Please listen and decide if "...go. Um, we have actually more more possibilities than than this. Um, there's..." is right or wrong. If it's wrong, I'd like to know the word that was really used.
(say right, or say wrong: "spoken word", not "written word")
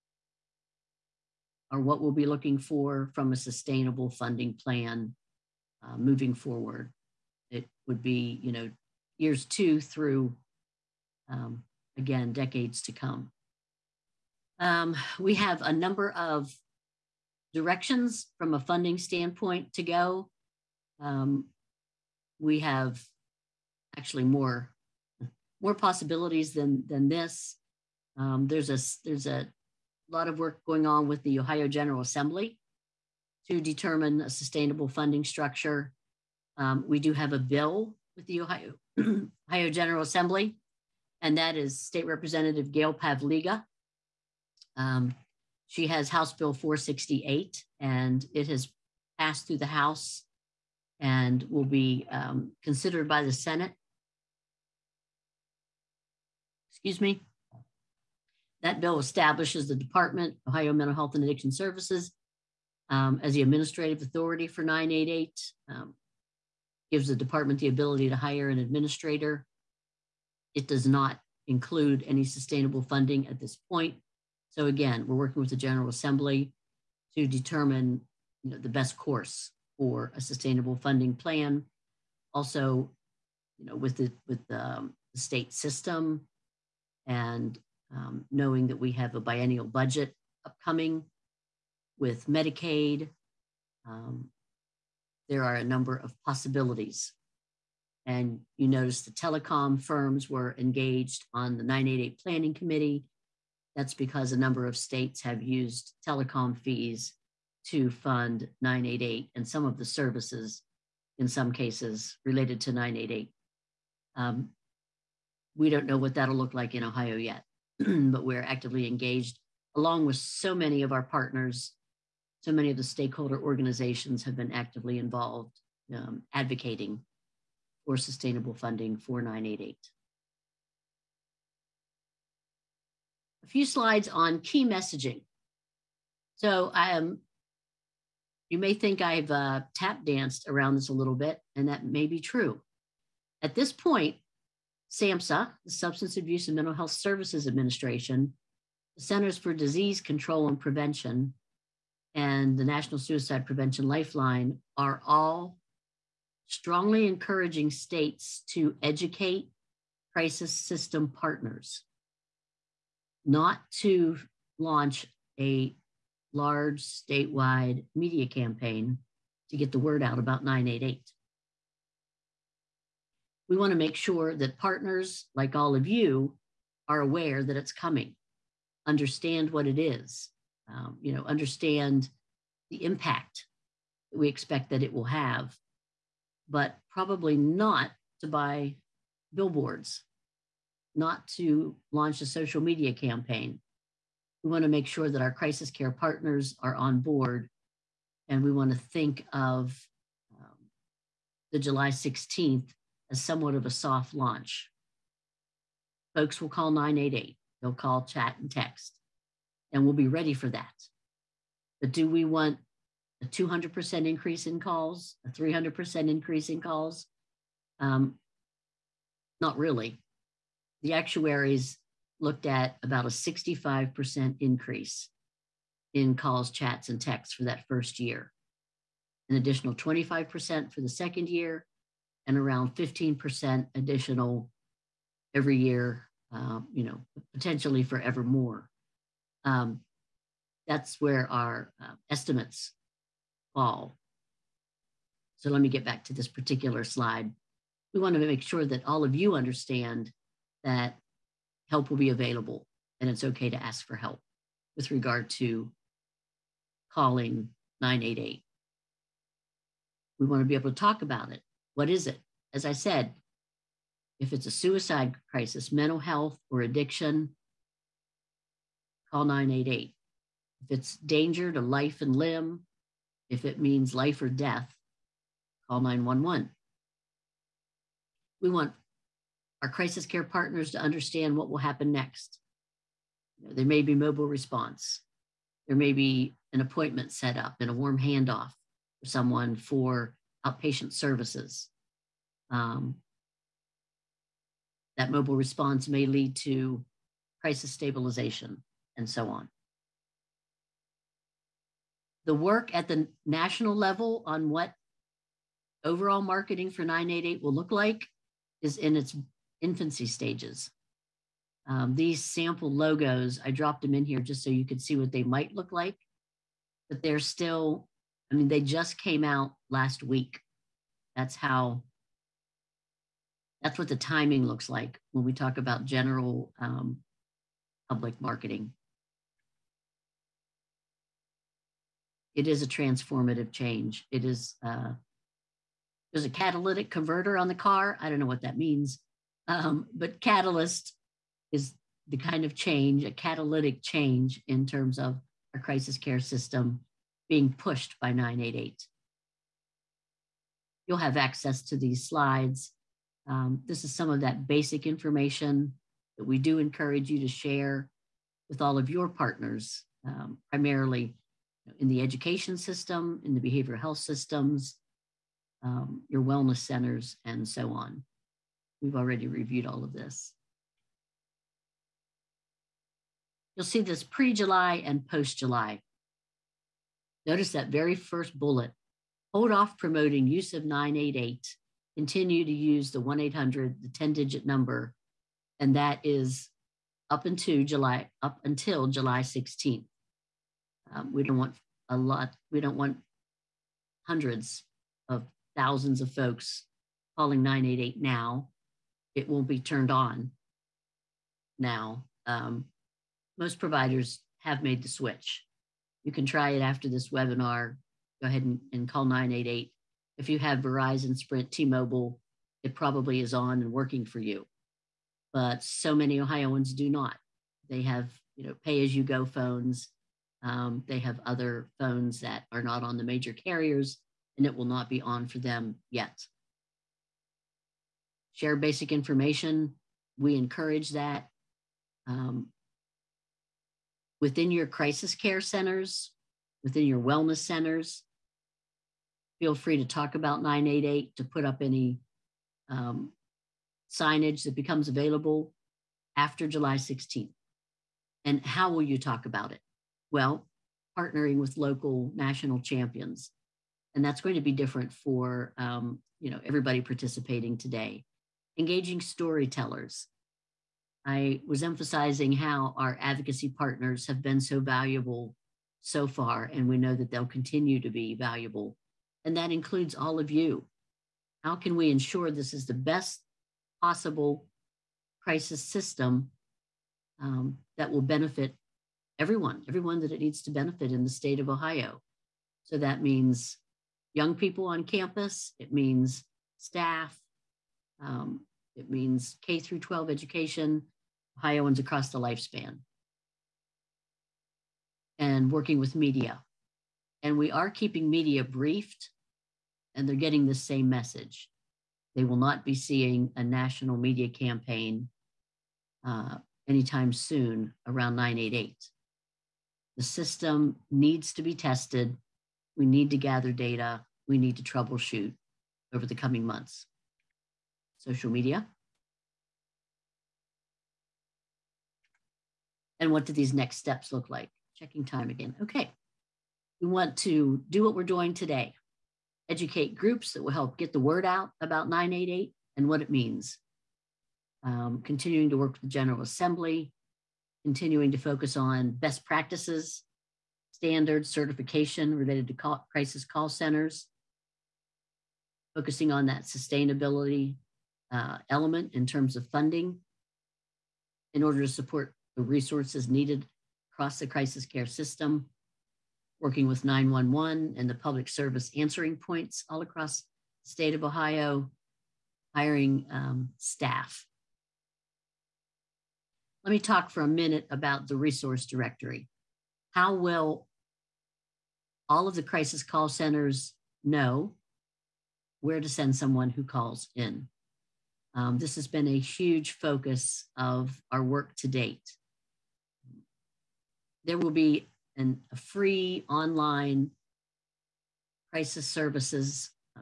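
right.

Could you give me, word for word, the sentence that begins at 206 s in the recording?
Folks will call 988, they'll call, chat, and text, and we'll be ready for that.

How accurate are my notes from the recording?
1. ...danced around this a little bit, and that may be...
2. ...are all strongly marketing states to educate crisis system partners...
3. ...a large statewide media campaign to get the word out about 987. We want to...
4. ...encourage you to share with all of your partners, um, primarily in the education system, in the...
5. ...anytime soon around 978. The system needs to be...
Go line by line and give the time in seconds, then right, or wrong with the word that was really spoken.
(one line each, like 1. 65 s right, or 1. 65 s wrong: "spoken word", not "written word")
1. 140 s right
2. 154 s wrong: "encouraging", not "marketing"
3. 165 s wrong: "988", not "987"
4. 356 s right
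5. 506 s wrong: "988", not "978".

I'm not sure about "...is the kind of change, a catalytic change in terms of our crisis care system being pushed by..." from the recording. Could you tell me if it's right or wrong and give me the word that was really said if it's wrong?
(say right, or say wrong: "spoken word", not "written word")
right.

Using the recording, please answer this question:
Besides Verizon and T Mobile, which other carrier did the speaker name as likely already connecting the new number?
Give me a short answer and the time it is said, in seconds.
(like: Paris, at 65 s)
Sprint, at 411 s.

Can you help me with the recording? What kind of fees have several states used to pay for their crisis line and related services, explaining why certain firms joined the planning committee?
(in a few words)
telecom fees.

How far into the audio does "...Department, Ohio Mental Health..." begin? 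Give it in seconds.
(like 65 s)
59 s.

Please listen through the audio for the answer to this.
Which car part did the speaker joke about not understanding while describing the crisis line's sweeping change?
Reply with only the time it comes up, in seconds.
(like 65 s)
336 s.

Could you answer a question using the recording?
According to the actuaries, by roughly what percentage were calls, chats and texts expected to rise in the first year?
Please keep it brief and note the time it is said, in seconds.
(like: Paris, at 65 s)
65%, at 223 s.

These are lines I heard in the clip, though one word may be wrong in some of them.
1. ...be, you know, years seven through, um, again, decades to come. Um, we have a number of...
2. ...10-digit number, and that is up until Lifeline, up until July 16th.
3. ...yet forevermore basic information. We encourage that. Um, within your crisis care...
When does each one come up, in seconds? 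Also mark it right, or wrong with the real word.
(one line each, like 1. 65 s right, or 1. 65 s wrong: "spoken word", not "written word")
1. 8 s wrong: "two", not "seven"
2. 383 s wrong: "July", not "Lifeline"
3. 425 s wrong: "share", not "forevermore".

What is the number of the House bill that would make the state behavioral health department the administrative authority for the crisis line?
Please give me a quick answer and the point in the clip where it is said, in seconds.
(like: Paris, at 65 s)
House Bill 468, at 46 s.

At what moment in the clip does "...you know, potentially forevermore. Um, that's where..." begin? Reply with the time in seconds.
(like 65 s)
236 s.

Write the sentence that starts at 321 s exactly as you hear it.
That's how, that's what the timing looks like when we talk about general um, public marketing.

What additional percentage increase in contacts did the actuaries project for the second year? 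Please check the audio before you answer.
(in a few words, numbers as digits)
25%.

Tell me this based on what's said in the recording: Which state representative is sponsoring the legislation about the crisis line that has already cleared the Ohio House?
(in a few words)
Gail Pavliga.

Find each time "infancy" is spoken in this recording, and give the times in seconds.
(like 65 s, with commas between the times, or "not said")
309 s.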